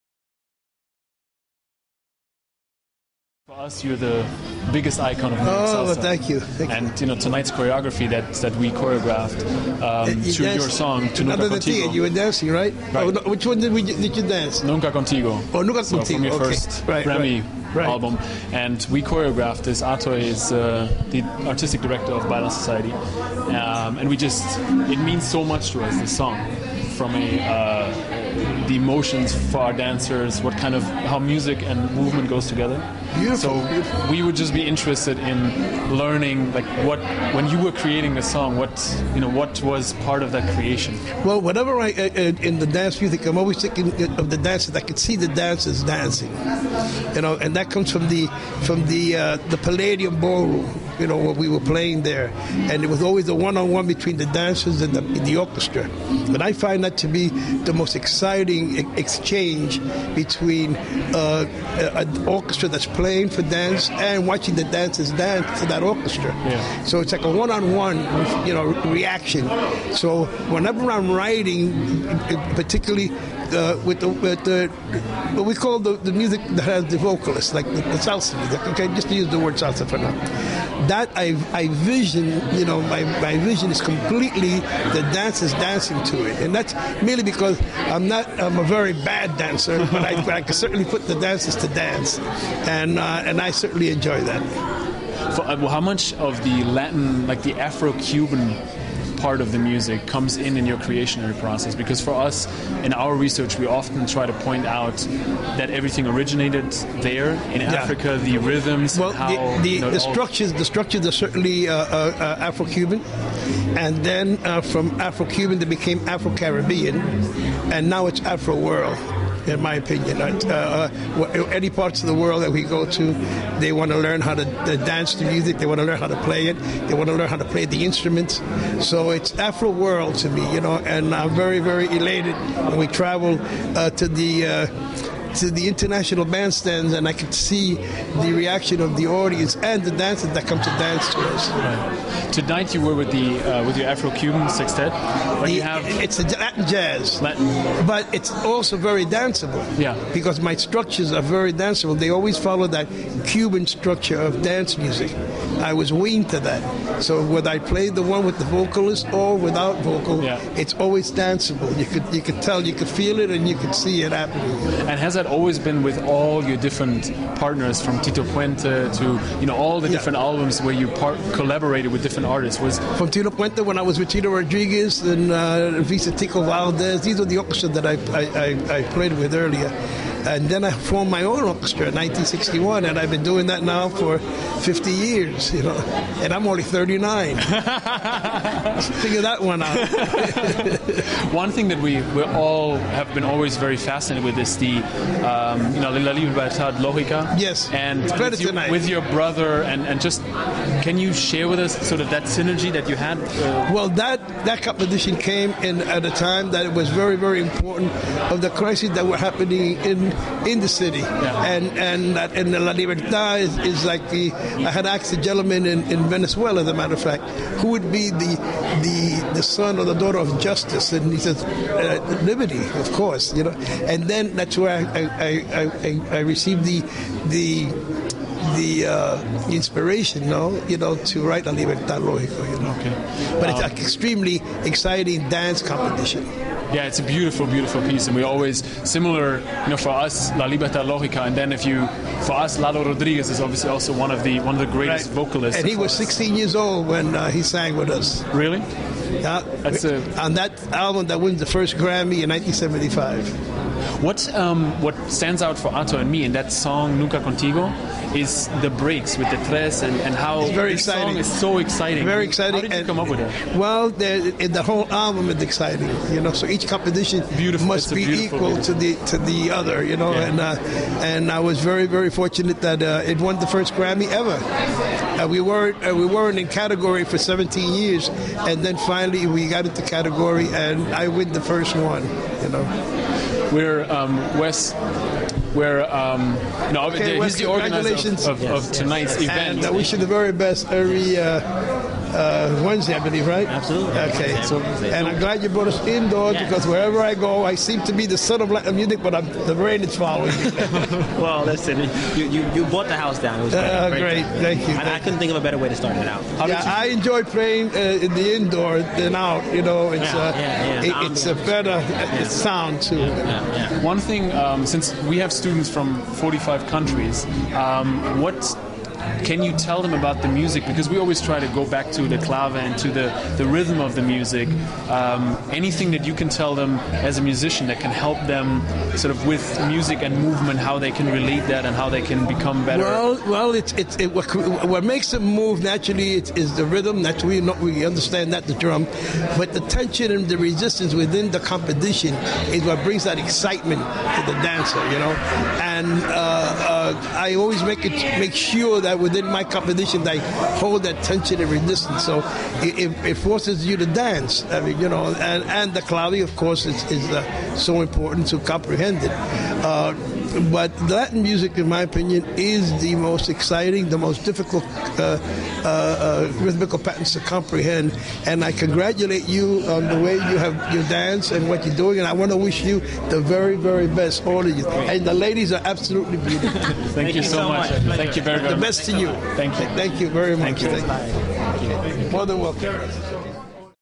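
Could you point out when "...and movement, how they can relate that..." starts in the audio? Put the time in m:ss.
5:30.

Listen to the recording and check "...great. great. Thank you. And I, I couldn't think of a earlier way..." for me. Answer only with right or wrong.
wrong.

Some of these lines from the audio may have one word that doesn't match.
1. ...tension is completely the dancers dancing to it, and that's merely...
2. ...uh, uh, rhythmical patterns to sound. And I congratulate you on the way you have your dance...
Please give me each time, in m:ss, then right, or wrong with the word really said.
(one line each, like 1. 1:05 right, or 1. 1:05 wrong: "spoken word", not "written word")
1. 1:23 wrong: "vision", not "tension"
2. 6:05 wrong: "comprehend", not "sound".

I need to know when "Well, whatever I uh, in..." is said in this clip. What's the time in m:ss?
0:41.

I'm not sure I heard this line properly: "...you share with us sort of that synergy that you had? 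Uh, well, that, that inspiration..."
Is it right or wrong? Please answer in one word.
wrong.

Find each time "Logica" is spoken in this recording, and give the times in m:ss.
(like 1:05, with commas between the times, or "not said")
3:16, 4:00.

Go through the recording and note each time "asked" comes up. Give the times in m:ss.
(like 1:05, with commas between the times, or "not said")
3:34.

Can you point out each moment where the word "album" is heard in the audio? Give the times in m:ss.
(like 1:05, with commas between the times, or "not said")
0:17, 2:50, 4:10, 4:24.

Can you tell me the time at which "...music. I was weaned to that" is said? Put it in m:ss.
2:34.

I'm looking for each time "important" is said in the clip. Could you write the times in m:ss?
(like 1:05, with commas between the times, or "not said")
3:27, 5:57.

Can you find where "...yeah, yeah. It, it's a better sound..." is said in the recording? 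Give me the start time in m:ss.
5:10.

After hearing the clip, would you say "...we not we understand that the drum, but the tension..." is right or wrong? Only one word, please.
right.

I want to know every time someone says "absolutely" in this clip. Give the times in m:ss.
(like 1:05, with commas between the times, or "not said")
4:53, 6:15.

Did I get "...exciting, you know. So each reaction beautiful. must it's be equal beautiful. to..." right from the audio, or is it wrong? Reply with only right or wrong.
wrong.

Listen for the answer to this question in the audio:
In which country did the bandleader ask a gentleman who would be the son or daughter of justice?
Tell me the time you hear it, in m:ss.
3:36.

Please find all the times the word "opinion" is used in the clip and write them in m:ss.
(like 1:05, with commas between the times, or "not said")
1:59, 6:01.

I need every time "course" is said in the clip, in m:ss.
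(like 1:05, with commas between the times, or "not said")
3:42, 5:56.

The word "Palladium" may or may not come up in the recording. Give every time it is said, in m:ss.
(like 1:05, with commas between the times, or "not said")
0:49.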